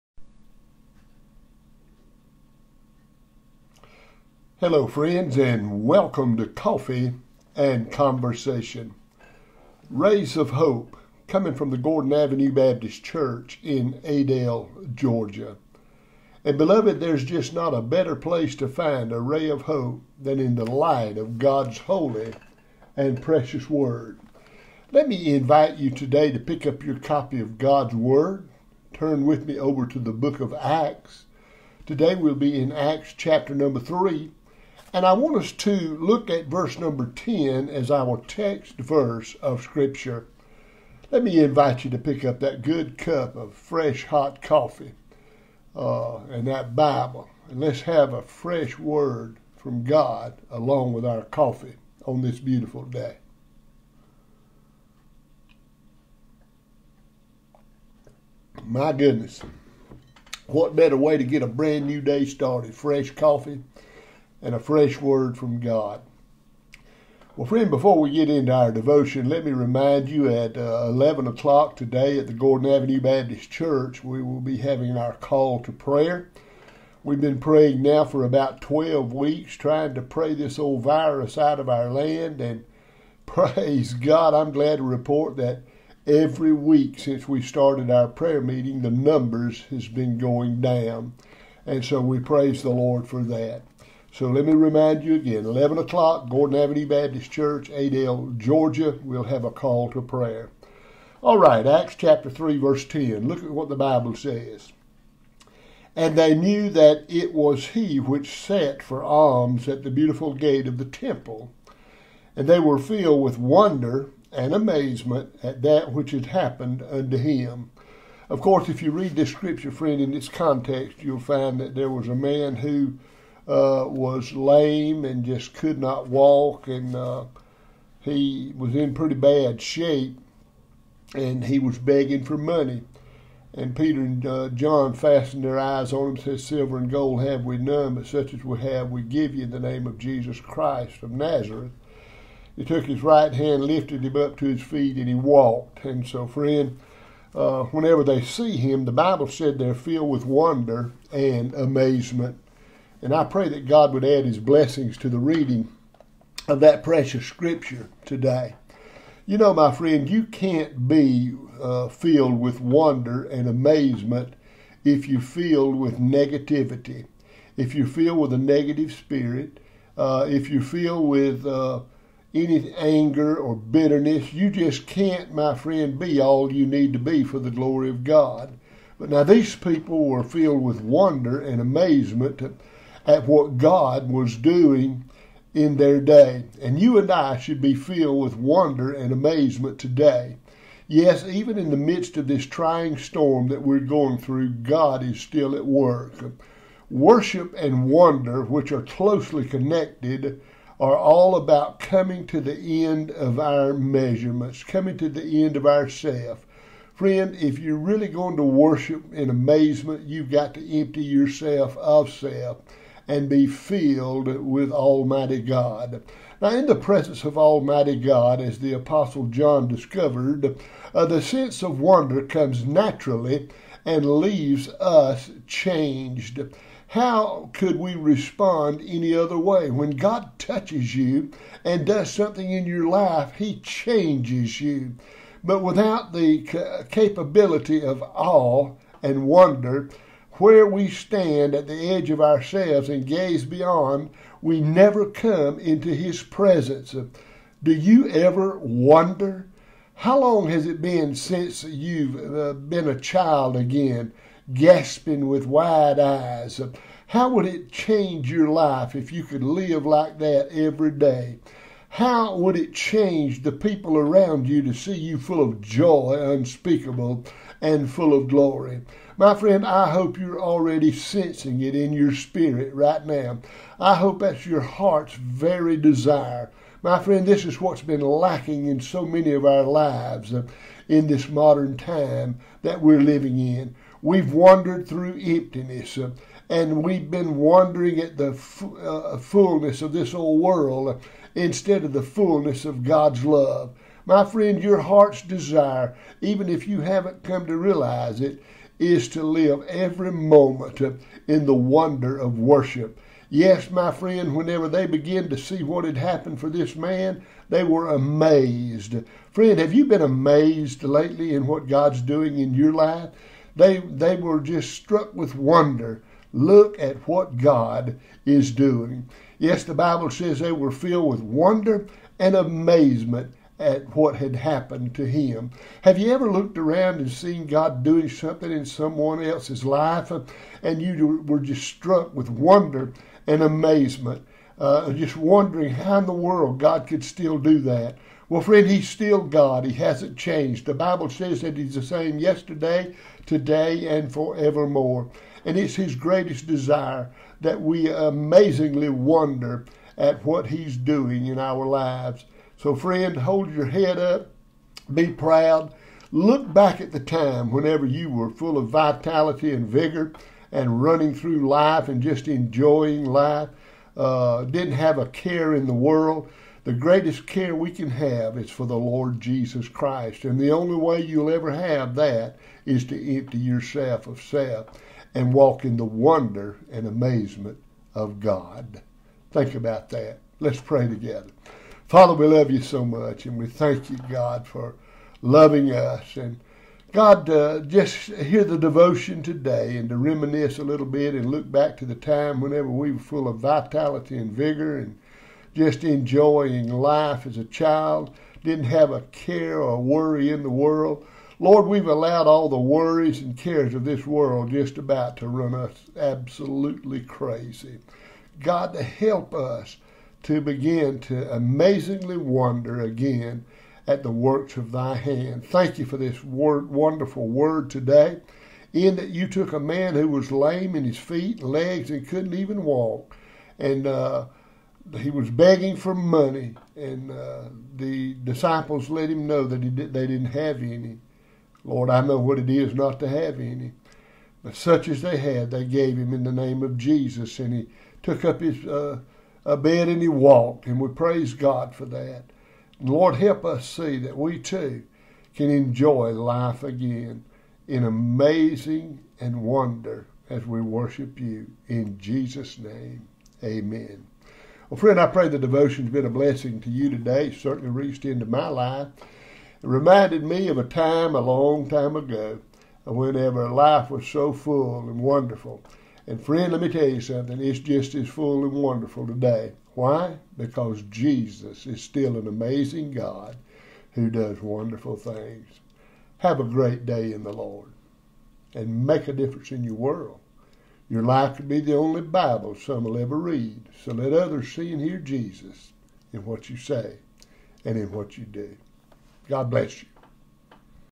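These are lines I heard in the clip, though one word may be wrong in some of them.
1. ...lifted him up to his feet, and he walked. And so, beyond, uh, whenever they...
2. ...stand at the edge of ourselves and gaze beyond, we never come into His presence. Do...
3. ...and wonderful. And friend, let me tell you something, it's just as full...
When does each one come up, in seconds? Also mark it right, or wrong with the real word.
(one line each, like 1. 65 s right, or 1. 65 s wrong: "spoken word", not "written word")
1. 143 s wrong: "friend", not "beyond"
2. 240 s right
3. 464 s right.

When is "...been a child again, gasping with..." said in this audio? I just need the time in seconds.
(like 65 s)
252 s.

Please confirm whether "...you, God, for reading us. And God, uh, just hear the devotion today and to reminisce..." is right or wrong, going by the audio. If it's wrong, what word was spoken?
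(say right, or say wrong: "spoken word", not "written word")
wrong: "loving", not "reading".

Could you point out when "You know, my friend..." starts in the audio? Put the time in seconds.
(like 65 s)
159 s.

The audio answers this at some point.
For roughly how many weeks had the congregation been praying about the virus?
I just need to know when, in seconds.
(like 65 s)
78 s.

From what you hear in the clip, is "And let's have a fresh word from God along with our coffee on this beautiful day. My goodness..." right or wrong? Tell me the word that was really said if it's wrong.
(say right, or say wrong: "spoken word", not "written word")
right.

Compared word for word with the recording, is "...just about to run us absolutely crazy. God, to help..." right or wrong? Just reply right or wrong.
right.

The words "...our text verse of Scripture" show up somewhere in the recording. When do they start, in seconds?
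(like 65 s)
37 s.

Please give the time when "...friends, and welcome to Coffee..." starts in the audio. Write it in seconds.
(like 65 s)
4 s.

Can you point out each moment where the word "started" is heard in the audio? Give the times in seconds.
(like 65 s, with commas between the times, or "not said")
62 s, 87 s.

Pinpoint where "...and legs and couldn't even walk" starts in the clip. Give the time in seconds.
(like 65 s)
421 s.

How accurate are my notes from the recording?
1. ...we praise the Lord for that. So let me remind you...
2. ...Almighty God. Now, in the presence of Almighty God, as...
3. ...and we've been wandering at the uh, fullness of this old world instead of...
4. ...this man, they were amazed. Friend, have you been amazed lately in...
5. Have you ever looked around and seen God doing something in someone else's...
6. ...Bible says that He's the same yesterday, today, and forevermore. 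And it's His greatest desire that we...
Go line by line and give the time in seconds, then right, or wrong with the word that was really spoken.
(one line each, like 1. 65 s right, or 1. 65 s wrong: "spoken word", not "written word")
1. 92 s right
2. 214 s right
3. 286 s right
4. 306 s right
5. 325 s right
6. 340 s right.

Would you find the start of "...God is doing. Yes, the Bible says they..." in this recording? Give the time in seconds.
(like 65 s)
317 s.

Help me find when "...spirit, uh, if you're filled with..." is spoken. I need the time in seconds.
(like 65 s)
168 s.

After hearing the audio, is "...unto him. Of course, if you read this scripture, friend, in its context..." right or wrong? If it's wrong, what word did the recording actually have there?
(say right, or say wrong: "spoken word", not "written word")
right.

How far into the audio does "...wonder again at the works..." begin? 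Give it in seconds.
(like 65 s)
412 s.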